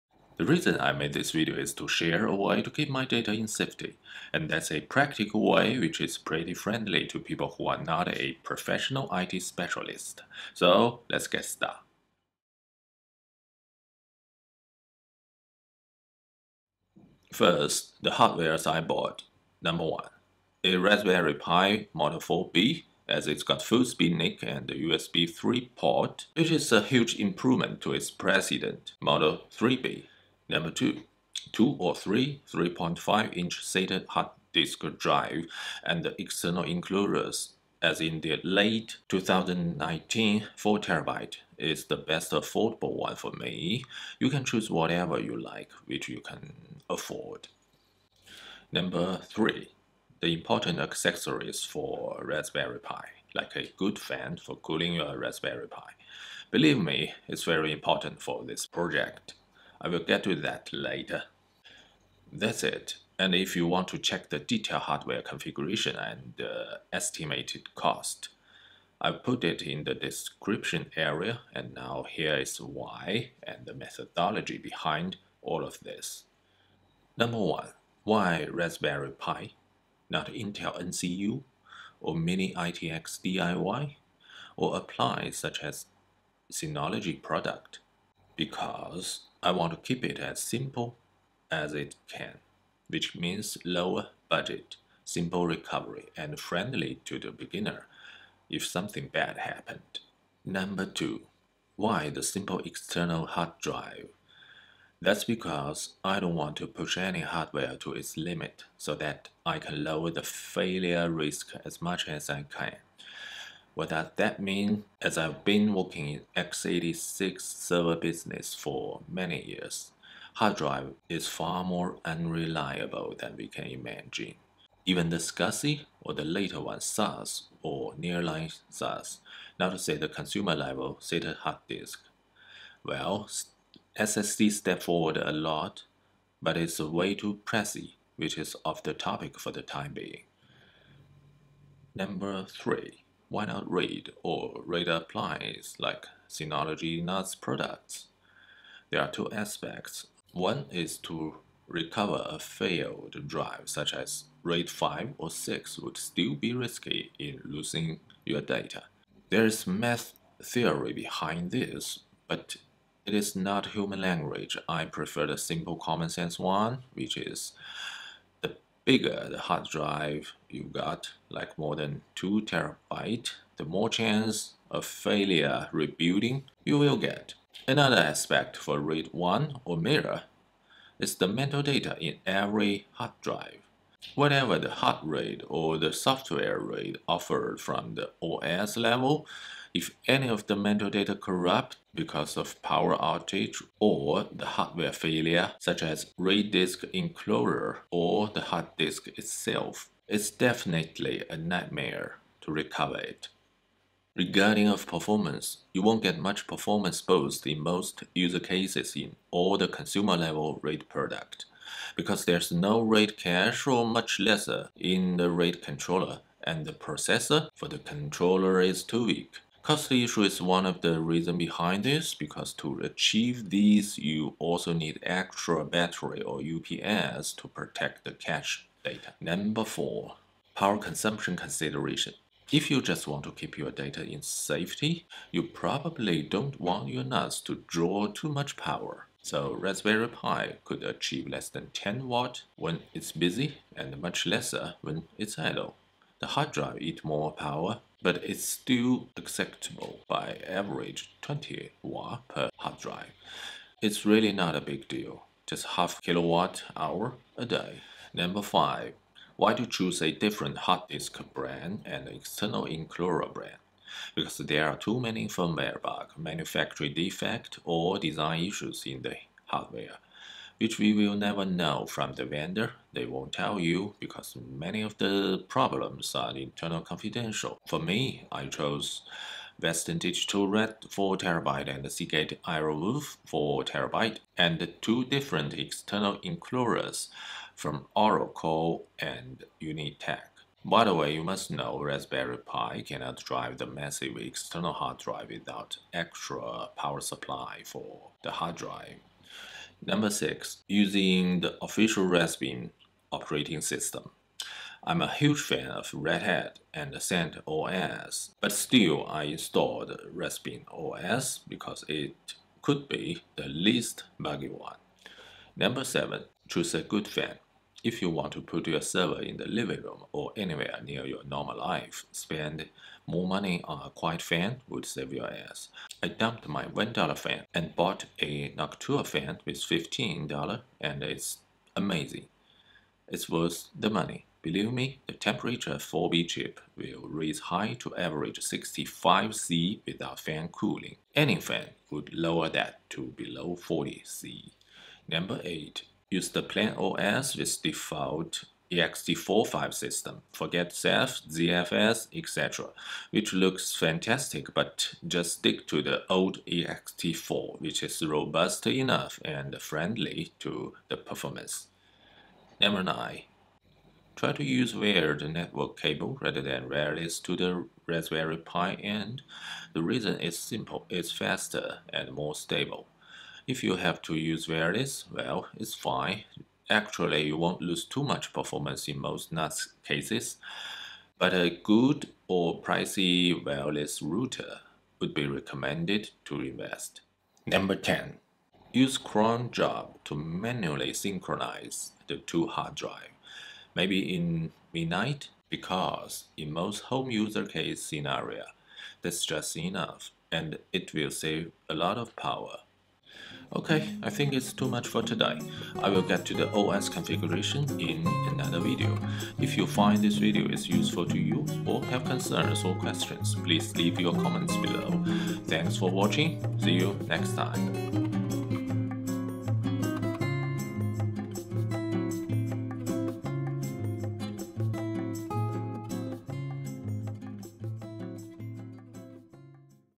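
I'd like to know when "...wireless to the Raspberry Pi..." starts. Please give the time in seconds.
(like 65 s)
366 s.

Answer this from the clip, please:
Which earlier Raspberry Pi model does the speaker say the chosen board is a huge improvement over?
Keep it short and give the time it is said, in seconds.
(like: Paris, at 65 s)
Model 3B, at 28 s.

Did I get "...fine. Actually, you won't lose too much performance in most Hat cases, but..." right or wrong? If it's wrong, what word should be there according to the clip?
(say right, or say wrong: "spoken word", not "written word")
wrong: "NAS", not "Hat".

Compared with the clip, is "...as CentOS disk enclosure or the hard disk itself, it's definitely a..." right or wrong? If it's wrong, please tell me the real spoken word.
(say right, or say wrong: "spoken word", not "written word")
wrong: "RAID", not "CentOS".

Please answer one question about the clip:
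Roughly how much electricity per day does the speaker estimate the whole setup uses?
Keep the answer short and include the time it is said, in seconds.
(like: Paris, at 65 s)
half kilowatt hour, at 255 s.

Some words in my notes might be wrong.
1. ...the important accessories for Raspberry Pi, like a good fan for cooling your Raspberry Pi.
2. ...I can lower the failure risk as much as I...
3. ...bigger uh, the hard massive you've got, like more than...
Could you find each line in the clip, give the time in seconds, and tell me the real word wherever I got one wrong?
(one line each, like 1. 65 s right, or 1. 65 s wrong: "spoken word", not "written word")
1. 50 s right
2. 109 s right
3. 168 s wrong: "drive", not "massive".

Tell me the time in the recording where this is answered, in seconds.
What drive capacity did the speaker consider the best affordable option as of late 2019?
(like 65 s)
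40 s.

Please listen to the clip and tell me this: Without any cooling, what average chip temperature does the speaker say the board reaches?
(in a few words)
65C.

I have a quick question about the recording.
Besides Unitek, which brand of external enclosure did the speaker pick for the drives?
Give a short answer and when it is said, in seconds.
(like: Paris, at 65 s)
ORICO, at 287 s.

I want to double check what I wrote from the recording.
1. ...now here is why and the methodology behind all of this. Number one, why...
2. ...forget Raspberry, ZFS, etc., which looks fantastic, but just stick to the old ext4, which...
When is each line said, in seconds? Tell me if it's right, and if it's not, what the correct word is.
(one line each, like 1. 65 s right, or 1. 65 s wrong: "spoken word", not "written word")
1. 71 s right
2. 350 s wrong: "Ceph", not "Raspberry".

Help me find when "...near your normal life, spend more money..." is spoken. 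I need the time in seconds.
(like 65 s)
320 s.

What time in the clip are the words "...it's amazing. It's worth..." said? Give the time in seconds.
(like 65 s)
331 s.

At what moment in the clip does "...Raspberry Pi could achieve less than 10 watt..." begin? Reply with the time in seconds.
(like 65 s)
239 s.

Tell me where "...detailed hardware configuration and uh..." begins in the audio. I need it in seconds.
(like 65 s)
64 s.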